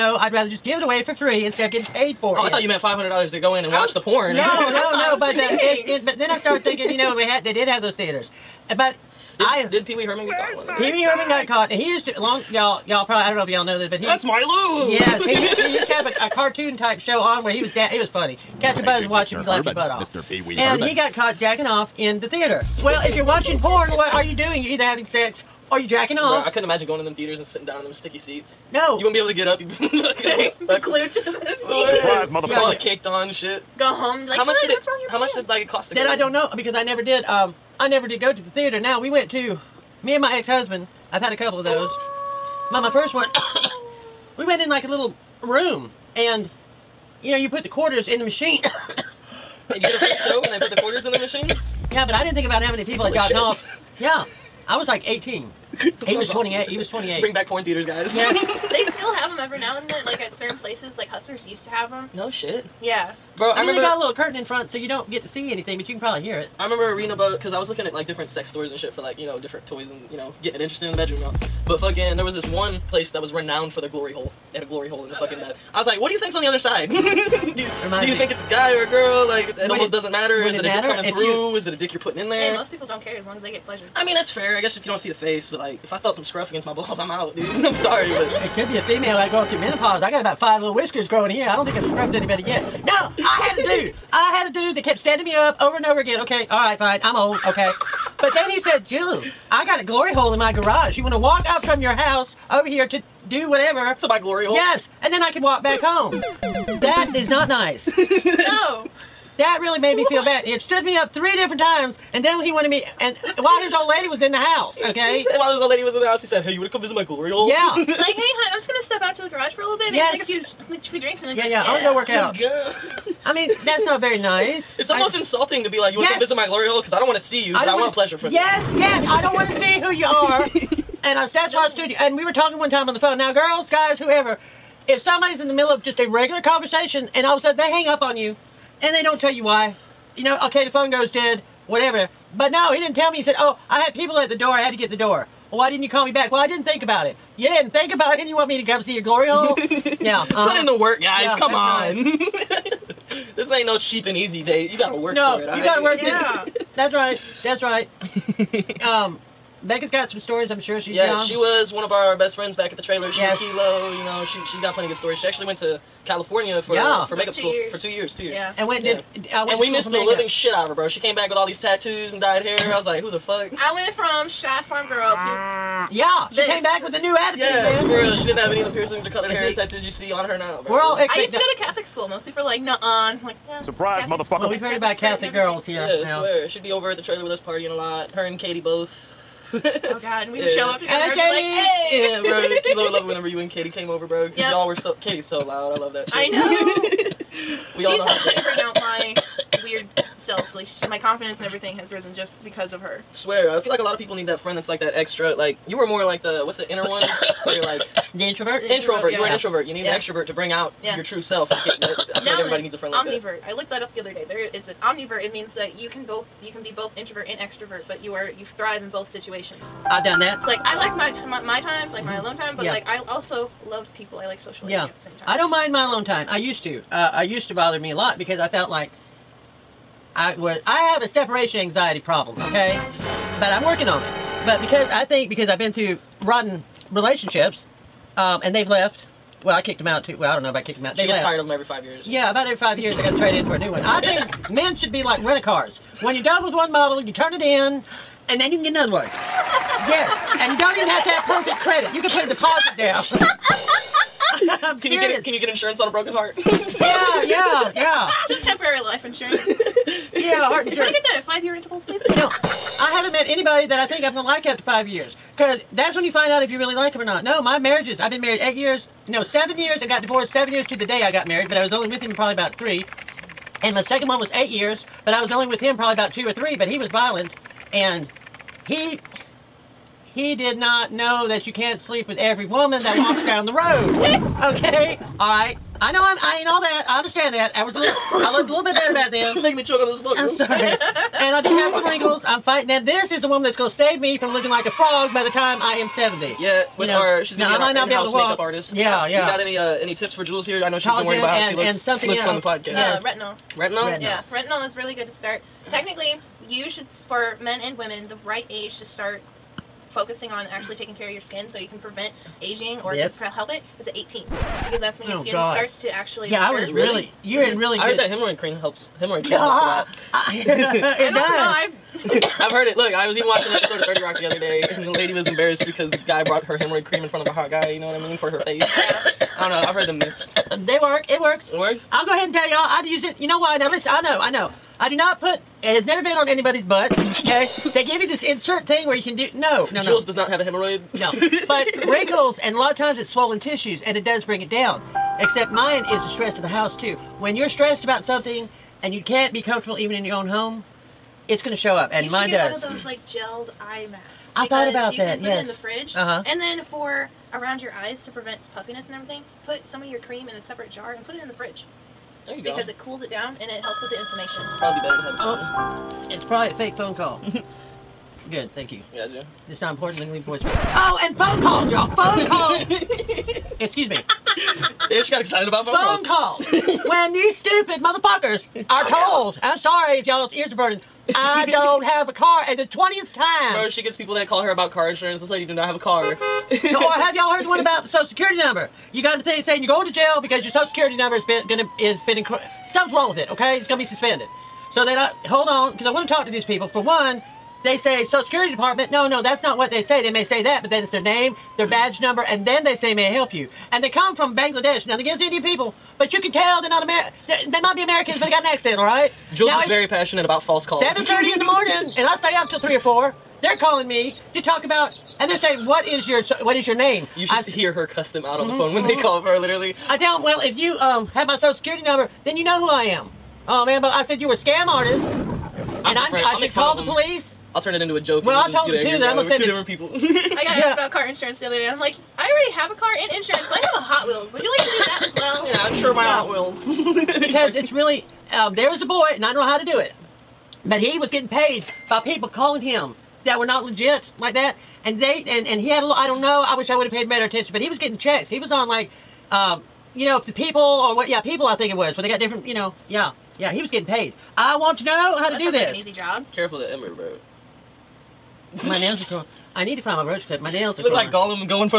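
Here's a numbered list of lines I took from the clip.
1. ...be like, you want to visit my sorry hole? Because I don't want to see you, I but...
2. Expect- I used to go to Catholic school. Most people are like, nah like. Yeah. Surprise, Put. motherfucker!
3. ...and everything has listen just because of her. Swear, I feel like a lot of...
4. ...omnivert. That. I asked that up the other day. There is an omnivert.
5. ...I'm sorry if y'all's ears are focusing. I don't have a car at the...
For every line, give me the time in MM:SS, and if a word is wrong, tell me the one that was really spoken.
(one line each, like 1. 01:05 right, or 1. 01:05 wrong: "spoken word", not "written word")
1. 02:05 wrong: "glory", not "sorry"
2. 03:00 wrong: "Catholic", not "Put"
3. 03:21 wrong: "risen", not "listen"
4. 03:33 wrong: "looked", not "asked"
5. 06:19 wrong: "burning", not "focusing".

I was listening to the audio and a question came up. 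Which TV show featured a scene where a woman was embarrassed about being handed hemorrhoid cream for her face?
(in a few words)
30 Rock.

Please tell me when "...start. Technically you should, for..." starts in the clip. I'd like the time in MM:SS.
05:05.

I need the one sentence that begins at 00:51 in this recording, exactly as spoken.
Yeah, but I didn't think about how many people Holy had gotten shit.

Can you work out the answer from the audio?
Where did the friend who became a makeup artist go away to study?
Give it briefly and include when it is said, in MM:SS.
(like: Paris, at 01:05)
California, at 02:46.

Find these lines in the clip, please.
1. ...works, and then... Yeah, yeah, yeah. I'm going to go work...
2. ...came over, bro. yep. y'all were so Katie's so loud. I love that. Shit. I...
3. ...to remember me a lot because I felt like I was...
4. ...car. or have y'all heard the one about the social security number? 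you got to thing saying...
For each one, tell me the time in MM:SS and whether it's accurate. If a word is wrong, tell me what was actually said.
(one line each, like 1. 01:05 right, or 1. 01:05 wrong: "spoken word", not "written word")
1. 02:00 wrong: "drinks", not "works"
2. 03:13 right
3. 03:47 wrong: "bother", not "remember"
4. 06:25 right.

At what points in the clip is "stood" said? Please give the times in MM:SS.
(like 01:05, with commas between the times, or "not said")
01:50, 02:11.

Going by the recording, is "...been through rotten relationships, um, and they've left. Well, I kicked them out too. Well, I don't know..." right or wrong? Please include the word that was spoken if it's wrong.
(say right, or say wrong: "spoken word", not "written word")
right.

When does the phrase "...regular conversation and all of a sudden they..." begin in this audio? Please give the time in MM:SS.
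02:16.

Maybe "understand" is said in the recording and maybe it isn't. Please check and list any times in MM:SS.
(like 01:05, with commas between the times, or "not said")
04:46.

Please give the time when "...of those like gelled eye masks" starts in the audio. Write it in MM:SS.
05:52.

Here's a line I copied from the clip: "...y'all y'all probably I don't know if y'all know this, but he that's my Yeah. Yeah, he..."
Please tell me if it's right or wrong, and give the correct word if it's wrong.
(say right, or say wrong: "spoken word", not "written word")
wrong: "Lou", not "Yeah".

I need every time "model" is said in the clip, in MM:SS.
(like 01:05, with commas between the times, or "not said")
04:06.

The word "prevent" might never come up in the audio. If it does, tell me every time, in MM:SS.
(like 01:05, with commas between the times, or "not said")
05:11, 05:58.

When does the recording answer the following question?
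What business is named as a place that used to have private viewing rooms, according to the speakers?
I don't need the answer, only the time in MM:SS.
01:01.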